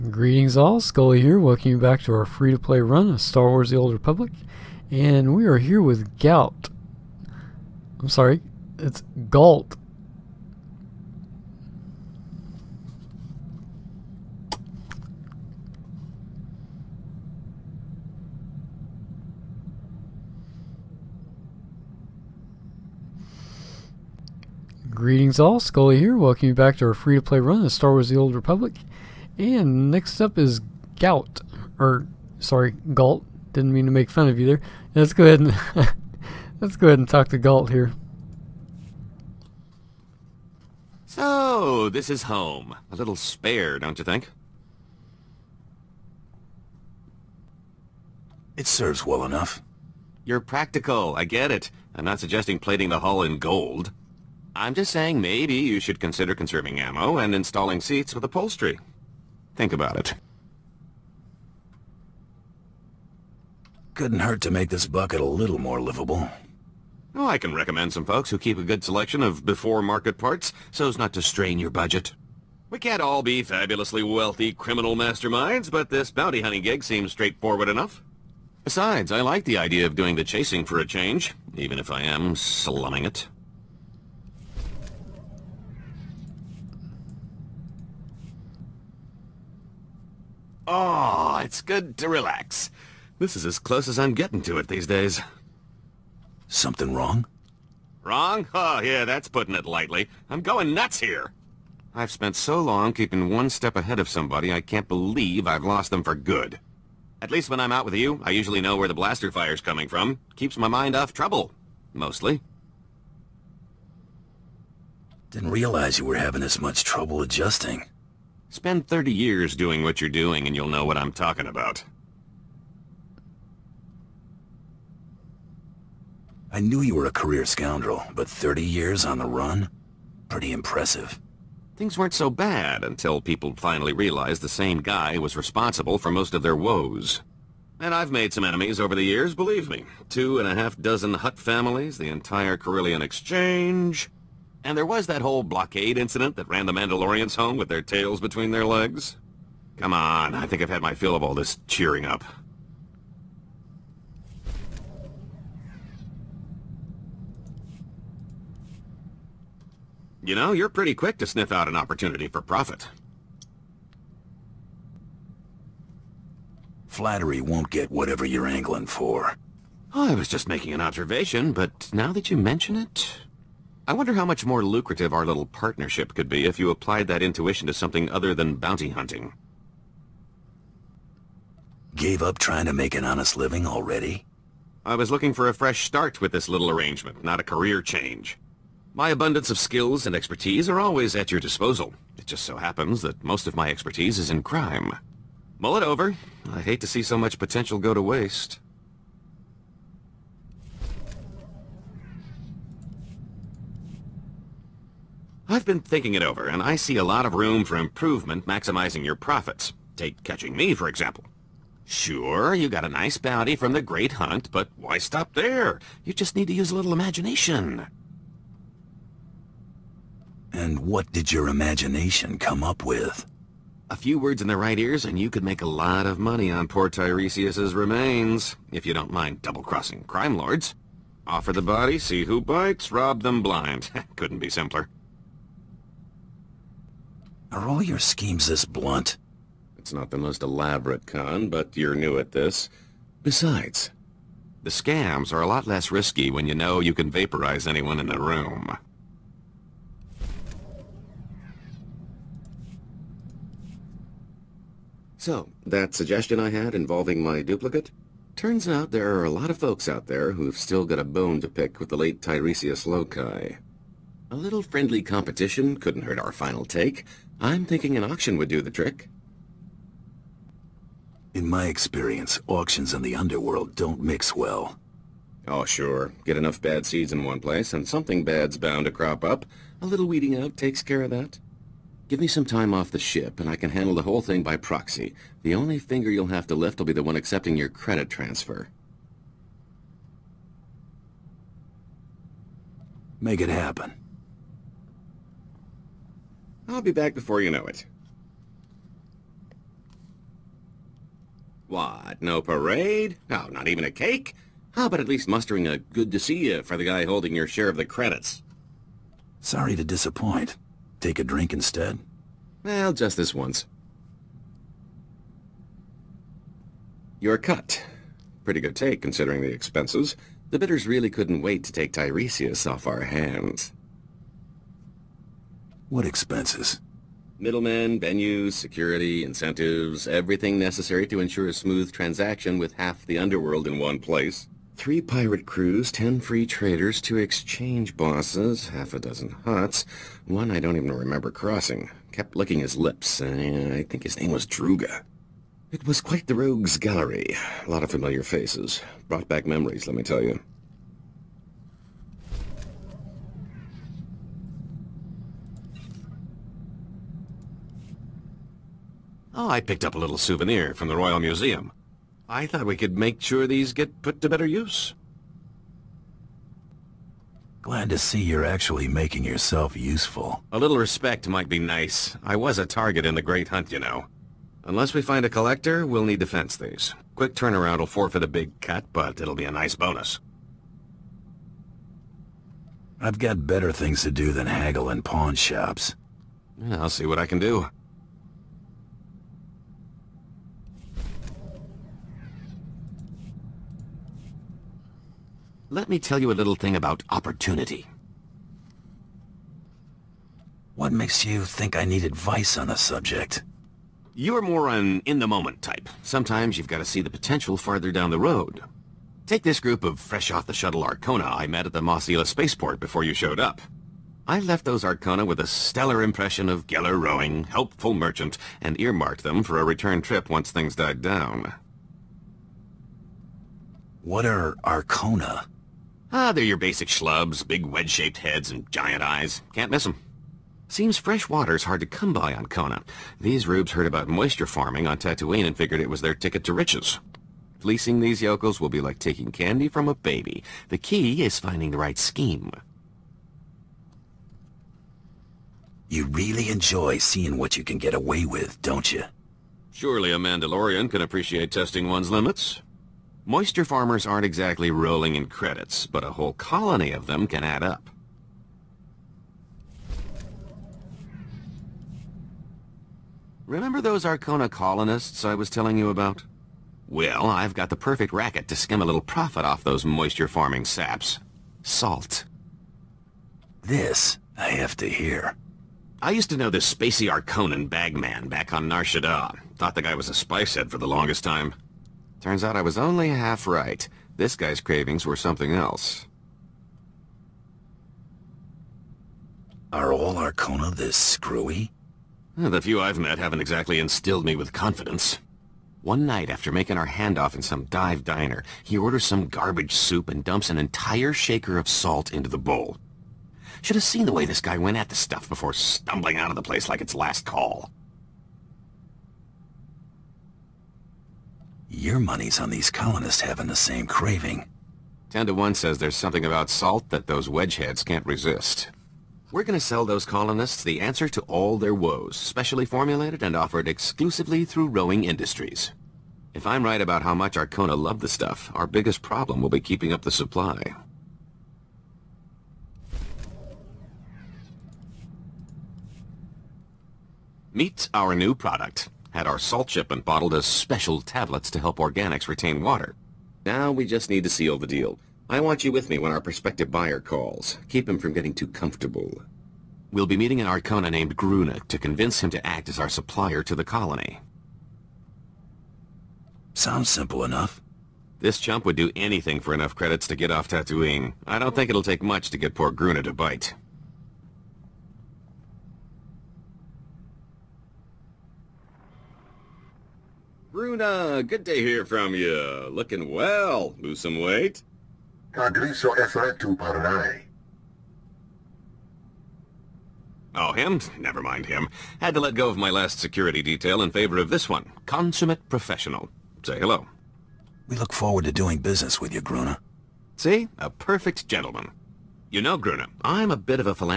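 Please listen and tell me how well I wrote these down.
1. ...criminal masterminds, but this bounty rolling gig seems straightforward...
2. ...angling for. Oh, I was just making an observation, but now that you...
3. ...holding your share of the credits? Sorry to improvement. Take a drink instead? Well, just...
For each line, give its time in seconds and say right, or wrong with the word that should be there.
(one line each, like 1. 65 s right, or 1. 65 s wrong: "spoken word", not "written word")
1. 74 s wrong: "hunting", not "rolling"
2. 168 s right
3. 307 s wrong: "disappoint", not "improvement".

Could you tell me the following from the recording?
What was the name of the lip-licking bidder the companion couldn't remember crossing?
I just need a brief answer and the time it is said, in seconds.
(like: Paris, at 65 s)
Druga, at 344 s.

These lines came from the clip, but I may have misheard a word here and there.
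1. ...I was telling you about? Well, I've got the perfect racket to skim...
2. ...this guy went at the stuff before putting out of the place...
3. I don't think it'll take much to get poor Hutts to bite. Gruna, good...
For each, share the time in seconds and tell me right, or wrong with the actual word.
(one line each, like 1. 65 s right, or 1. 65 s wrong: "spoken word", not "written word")
1. 465 s right
2. 504 s wrong: "stumbling", not "putting"
3. 561 s wrong: "Gruna", not "Hutts".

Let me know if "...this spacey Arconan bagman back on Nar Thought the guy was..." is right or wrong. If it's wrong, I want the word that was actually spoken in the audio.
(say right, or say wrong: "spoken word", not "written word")
right.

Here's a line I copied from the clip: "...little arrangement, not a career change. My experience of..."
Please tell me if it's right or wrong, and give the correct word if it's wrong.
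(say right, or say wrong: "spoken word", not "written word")
wrong: "abundance", not "experience".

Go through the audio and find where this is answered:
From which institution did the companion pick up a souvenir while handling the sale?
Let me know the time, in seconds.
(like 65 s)
360 s.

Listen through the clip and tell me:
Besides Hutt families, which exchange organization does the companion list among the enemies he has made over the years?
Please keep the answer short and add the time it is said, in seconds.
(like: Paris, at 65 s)
Carillion Exchange, at 142 s.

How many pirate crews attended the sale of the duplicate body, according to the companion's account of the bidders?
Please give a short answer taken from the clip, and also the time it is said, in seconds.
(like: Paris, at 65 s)
3, at 334 s.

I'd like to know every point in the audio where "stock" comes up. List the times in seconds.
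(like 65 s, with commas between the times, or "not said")
not said.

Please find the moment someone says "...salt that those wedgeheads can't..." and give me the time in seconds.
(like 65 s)
516 s.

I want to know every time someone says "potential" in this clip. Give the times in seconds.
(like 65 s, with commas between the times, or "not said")
197 s, 407 s.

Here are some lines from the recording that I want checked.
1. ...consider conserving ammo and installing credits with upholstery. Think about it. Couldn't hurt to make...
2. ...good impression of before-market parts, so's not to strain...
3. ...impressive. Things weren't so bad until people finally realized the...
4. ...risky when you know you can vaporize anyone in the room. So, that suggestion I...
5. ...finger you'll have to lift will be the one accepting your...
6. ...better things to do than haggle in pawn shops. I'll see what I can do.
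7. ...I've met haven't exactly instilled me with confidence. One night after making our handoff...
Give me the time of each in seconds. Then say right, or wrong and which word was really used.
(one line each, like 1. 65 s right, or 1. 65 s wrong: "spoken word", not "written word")
1. 55 s wrong: "seats", not "credits"
2. 68 s wrong: "selection", not "impression"
3. 130 s right
4. 245 s right
5. 285 s right
6. 383 s right
7. 492 s right.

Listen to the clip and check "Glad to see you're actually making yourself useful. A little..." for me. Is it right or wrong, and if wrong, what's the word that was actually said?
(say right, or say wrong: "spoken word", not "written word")
right.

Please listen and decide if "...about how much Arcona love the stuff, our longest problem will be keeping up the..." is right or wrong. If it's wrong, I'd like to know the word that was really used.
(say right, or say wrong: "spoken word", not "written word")
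wrong: "biggest", not "longest".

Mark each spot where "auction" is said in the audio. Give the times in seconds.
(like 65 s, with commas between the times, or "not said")
268 s, 272 s.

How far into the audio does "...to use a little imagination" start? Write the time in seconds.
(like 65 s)
216 s.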